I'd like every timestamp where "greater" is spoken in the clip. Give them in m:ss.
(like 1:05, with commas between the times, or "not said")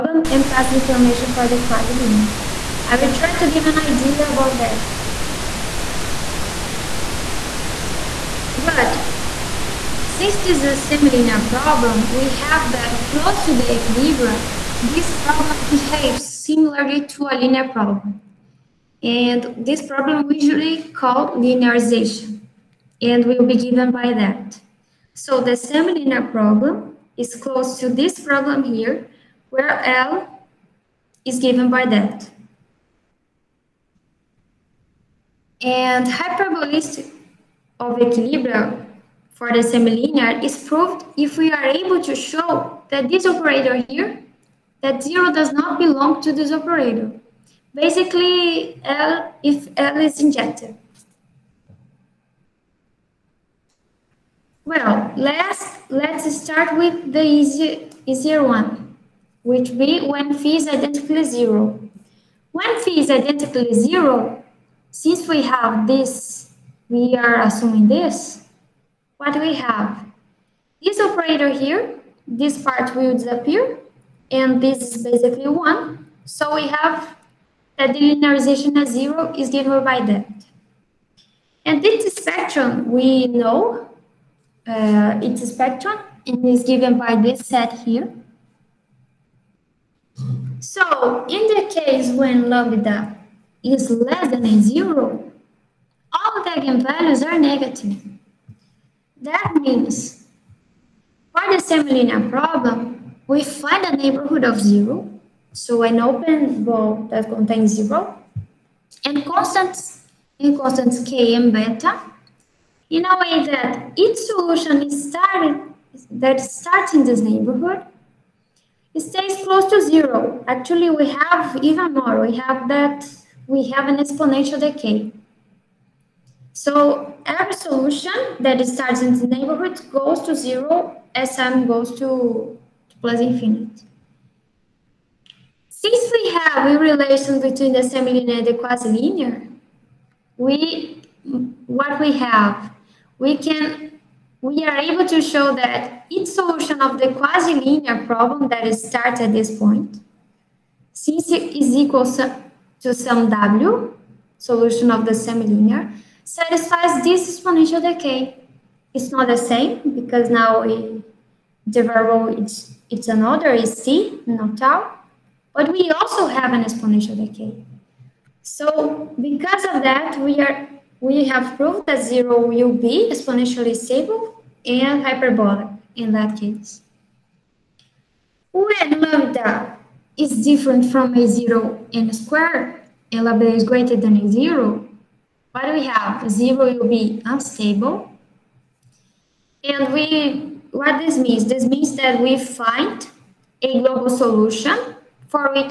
3:03.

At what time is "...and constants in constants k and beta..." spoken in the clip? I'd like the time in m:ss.
1:49.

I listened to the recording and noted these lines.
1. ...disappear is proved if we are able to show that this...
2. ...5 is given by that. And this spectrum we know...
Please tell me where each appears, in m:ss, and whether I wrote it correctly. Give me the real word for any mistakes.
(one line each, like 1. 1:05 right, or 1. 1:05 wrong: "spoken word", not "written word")
1. 0:39 wrong: "semilinear", not "disappear"
2. 1:18 wrong: "0", not "5".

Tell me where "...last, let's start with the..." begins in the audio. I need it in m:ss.
0:55.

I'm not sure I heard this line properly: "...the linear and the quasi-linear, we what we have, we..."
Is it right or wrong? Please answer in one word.
wrong.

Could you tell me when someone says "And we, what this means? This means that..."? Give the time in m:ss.
3:09.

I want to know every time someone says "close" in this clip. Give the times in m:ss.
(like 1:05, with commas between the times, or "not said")
0:13, 0:27, 1:59.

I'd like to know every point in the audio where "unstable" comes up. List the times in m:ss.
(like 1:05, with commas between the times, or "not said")
3:07.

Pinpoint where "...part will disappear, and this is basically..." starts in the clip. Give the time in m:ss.
1:12.